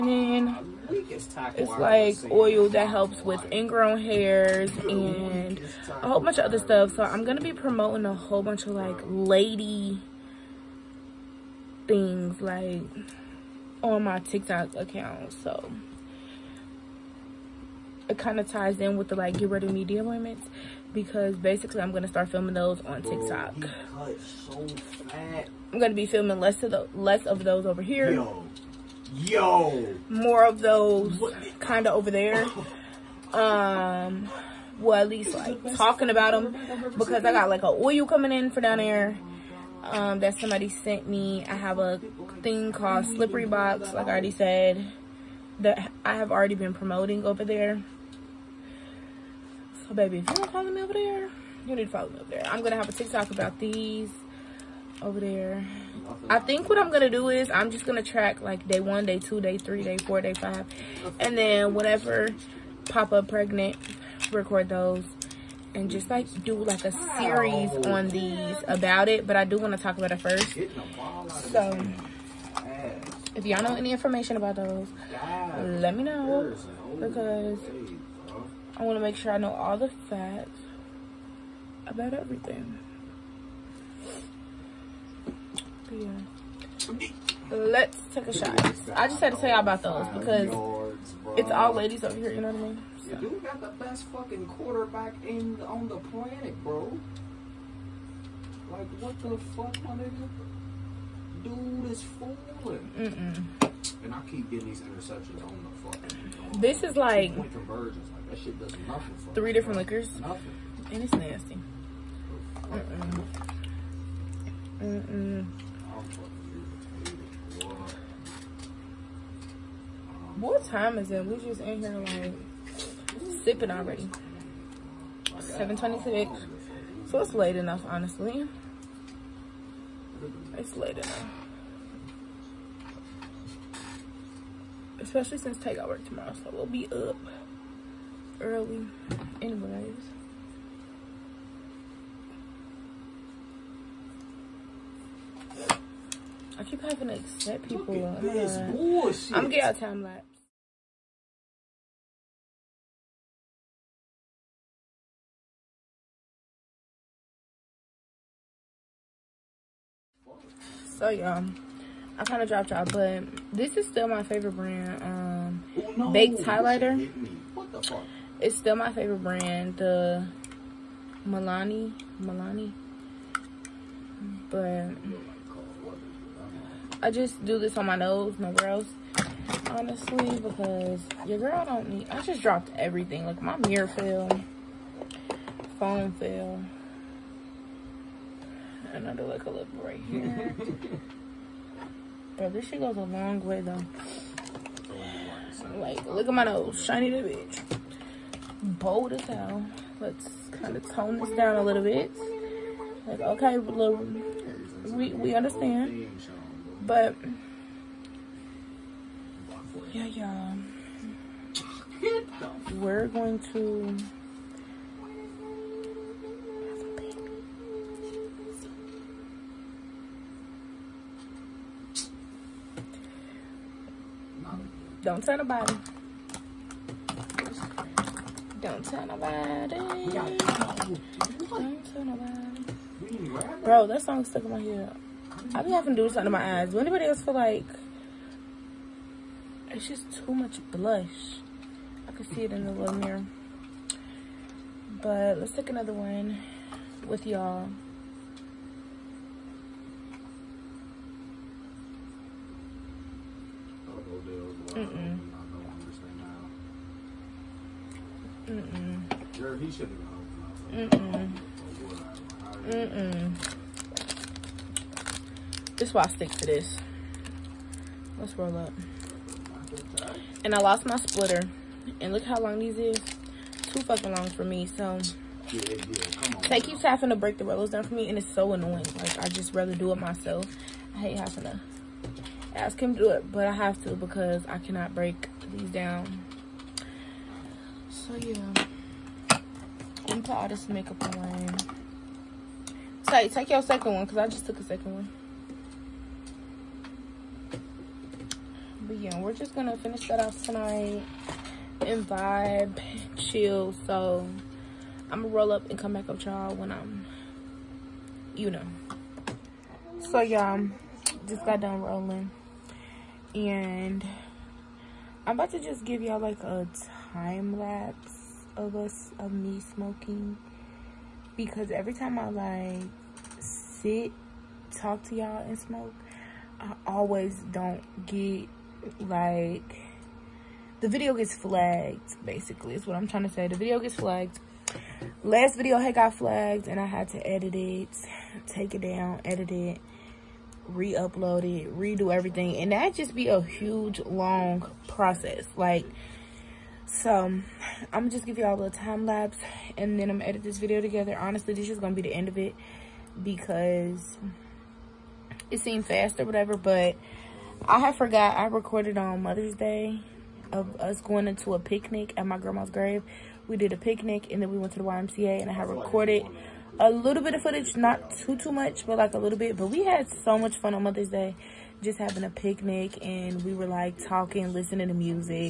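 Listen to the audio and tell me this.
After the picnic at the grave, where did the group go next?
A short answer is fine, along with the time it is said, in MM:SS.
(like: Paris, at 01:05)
the YMCA, at 06:04.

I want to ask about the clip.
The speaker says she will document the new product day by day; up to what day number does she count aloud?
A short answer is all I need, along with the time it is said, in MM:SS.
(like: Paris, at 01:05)
5, at 01:00.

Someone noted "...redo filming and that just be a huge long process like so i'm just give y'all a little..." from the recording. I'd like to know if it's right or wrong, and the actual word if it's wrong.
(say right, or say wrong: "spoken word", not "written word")
wrong: "everything", not "filming".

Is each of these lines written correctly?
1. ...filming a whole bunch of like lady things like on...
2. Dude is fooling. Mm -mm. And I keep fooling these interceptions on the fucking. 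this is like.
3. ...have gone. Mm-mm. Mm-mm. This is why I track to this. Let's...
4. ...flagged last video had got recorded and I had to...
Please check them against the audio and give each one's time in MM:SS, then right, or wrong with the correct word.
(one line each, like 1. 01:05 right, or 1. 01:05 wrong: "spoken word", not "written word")
1. 00:07 wrong: "promoting", not "filming"
2. 01:41 wrong: "getting", not "fooling"
3. 04:19 wrong: "stick", not "track"
4. 05:33 wrong: "flagged", not "recorded".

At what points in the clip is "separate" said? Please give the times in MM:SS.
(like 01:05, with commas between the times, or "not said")
not said.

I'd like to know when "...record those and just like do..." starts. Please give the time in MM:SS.
01:04.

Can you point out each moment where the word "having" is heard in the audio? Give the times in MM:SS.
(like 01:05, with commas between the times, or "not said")
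02:26, 03:55, 04:36, 04:41, 06:11.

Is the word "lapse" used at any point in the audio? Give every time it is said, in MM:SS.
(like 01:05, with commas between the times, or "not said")
02:30, 05:17, 05:49.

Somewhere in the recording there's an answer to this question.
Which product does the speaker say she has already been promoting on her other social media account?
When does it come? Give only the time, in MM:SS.
00:43.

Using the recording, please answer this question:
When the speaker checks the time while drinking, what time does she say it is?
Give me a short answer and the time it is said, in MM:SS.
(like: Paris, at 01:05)
7:26, at 02:05.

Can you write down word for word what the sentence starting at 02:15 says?
Especially since takeout work tomorrow, so we'll be up early.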